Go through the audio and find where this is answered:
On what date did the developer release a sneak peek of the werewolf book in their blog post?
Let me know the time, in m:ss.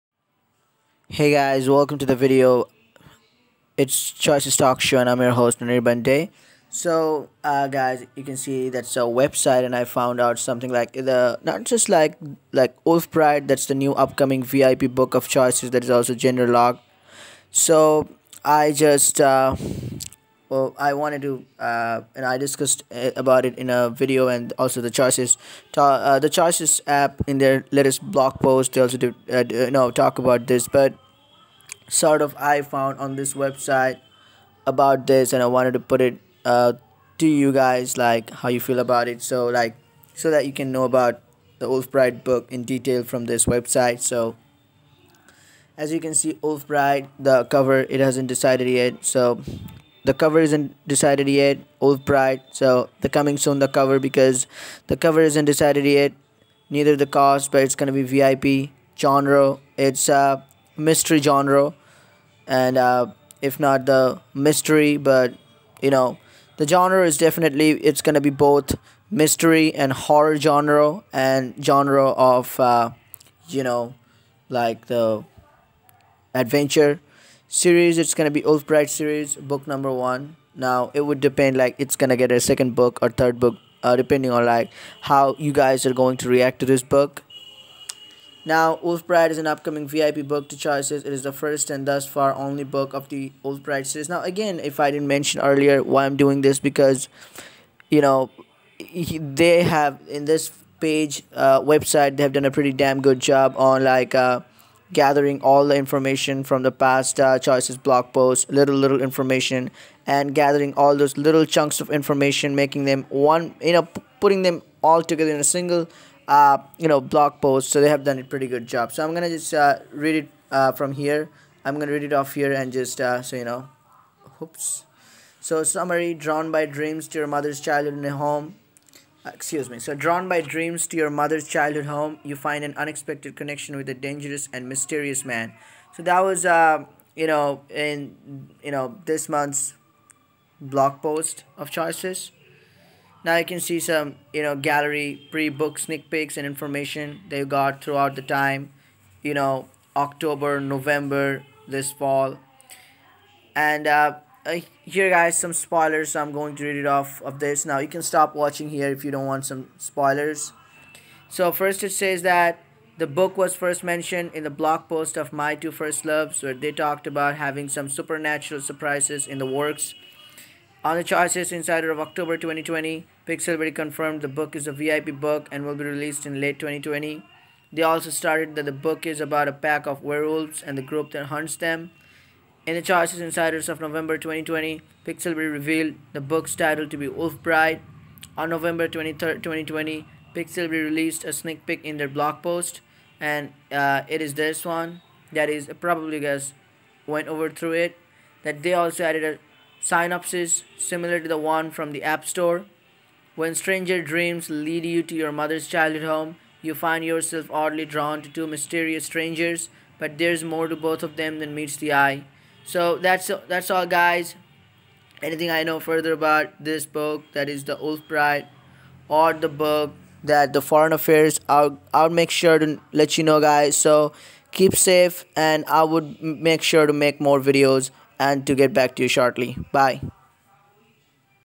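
3:08.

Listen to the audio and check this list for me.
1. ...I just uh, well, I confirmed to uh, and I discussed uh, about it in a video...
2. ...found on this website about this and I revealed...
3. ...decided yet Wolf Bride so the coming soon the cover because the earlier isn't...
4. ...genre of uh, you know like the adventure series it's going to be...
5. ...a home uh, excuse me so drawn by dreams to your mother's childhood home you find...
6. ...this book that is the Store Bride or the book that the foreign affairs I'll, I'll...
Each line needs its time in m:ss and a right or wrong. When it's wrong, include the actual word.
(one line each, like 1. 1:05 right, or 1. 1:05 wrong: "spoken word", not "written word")
1. 0:18 wrong: "wanted", not "confirmed"
2. 0:32 wrong: "wanted", not "revealed"
3. 0:50 wrong: "cover", not "earlier"
4. 1:11 right
5. 2:08 right
6. 3:36 wrong: "Old", not "Store".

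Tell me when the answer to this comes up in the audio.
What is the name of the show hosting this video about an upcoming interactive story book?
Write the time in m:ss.
0:04.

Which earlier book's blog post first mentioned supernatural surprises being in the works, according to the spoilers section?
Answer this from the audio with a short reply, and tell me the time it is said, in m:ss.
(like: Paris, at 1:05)
My Two First Loves, at 2:45.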